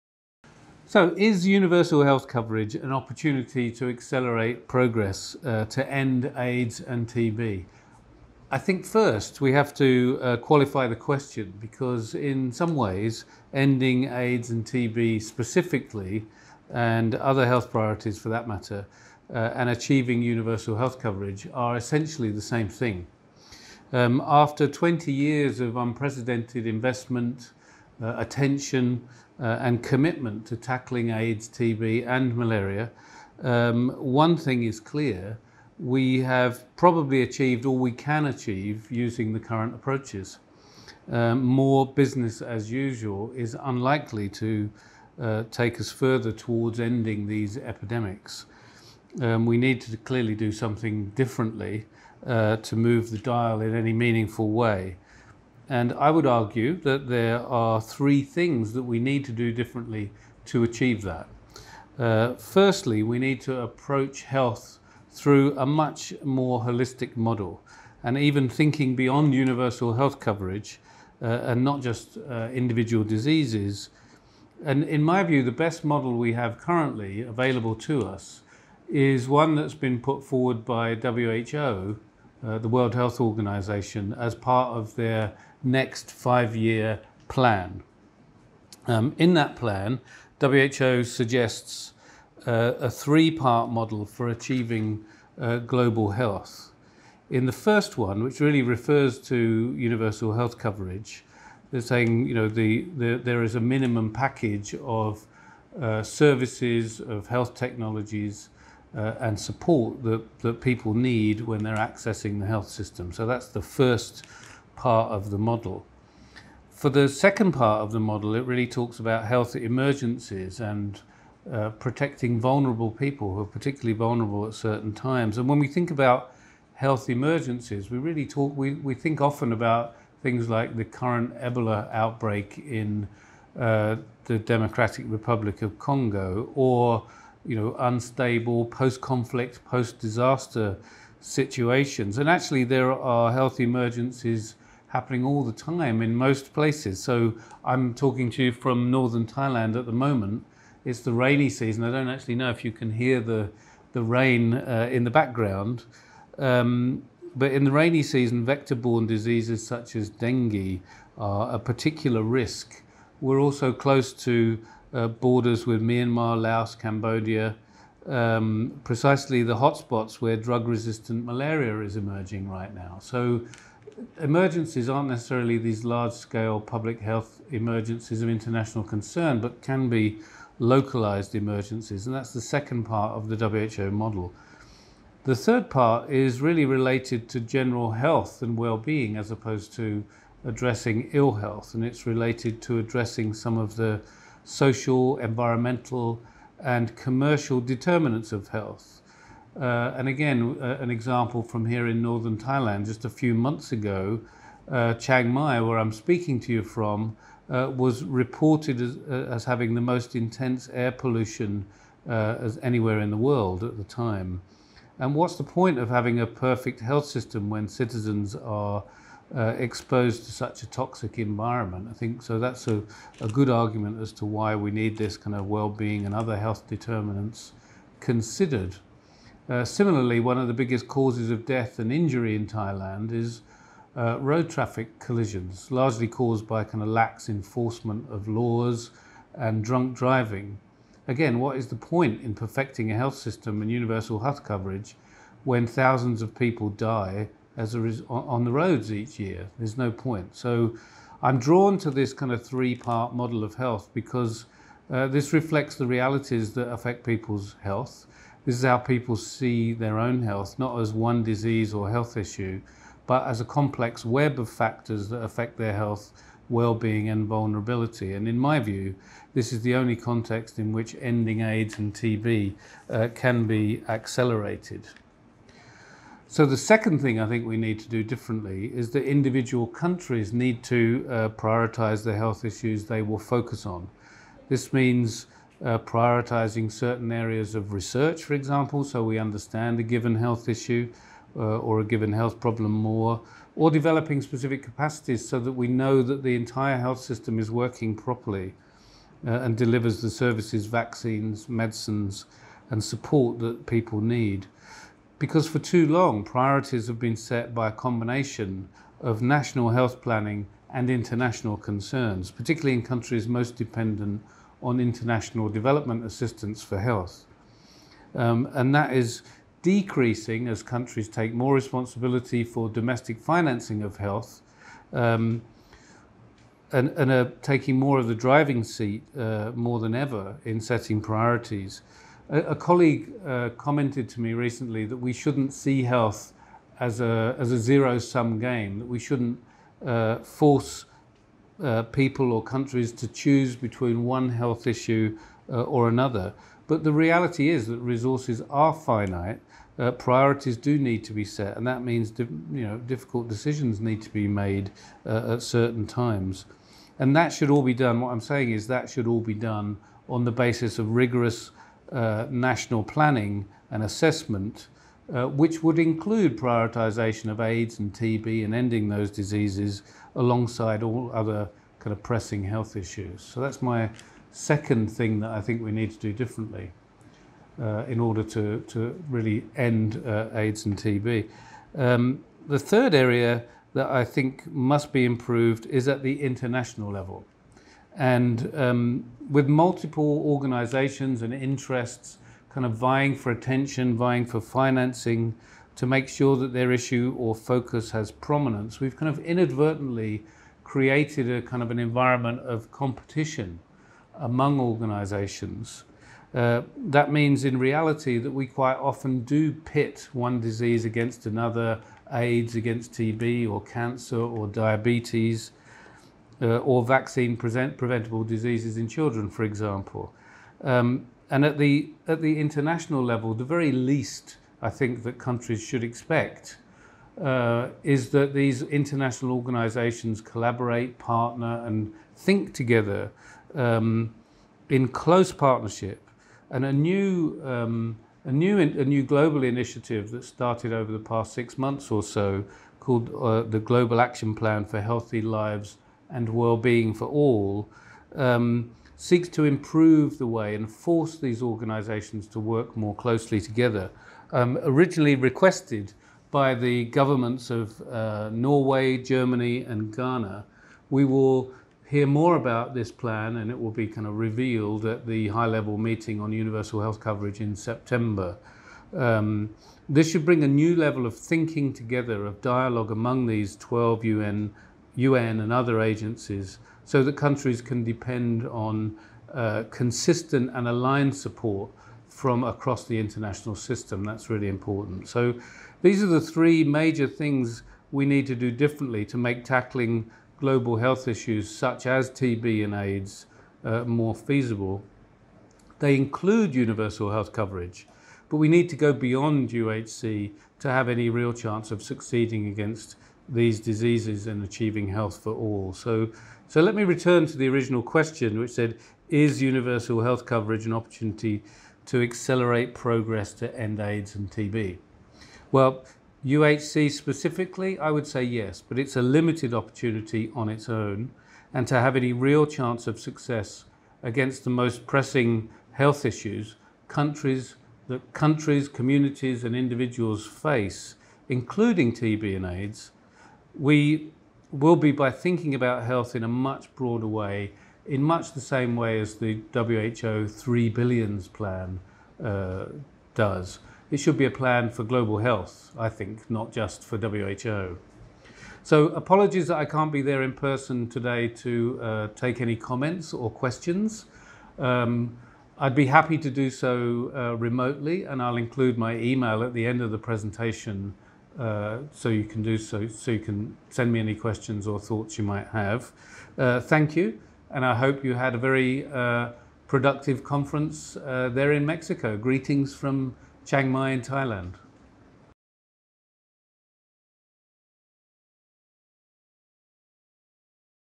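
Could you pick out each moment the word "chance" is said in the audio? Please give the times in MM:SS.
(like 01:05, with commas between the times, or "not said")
08:21, 08:42.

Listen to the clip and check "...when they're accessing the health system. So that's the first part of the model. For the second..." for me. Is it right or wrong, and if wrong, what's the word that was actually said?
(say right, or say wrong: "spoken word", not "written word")
right.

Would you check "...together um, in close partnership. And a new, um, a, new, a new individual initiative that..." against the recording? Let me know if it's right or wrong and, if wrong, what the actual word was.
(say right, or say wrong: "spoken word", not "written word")
wrong: "global", not "individual".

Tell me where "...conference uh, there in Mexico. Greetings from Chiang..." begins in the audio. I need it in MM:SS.
09:30.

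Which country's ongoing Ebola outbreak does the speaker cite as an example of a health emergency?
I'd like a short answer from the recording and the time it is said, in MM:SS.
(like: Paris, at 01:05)
Democratic Republic of Congo, at 02:14.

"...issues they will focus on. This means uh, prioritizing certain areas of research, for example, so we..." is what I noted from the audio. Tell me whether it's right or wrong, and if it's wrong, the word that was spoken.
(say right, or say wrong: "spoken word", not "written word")
right.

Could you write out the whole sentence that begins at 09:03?
It should be a plan for global health, I think, not just for WHO.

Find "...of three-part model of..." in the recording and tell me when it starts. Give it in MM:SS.
04:12.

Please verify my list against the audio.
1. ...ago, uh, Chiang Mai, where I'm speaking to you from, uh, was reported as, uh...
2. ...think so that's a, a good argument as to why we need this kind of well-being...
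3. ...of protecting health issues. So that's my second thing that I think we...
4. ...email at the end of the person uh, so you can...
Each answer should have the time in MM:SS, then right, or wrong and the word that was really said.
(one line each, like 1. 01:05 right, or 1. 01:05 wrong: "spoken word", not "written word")
1. 03:23 right
2. 03:41 right
3. 06:11 wrong: "pressing", not "protecting"
4. 09:18 wrong: "presentation", not "person".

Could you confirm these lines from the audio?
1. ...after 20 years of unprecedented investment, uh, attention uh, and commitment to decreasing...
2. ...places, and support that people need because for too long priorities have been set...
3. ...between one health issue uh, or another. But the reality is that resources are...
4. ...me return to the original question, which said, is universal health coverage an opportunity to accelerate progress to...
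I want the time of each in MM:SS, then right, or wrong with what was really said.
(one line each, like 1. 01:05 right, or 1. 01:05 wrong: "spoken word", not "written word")
1. 00:24 wrong: "tackling", not "decreasing"
2. 05:01 wrong: "medicines", not "places"
3. 05:43 right
4. 08:26 right.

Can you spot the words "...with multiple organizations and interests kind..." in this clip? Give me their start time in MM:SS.
06:29.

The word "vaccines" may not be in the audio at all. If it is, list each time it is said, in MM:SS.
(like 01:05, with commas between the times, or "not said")
05:00, 06:56.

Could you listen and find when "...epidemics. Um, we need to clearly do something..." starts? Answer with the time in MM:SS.
00:47.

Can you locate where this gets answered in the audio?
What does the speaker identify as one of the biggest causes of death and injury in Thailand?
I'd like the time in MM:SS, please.
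03:54.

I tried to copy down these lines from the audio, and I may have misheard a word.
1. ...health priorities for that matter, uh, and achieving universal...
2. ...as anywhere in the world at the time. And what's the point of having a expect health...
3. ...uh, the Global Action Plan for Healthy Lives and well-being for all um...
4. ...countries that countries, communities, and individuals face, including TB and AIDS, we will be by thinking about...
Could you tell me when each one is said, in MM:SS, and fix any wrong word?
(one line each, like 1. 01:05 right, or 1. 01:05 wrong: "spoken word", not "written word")
1. 00:17 right
2. 03:32 wrong: "perfect", not "expect"
3. 07:23 right
4. 08:46 right.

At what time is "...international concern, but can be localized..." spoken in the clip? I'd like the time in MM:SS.
02:58.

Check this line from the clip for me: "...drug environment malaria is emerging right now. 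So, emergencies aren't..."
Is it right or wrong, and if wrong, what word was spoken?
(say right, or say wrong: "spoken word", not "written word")
wrong: "resistant", not "environment".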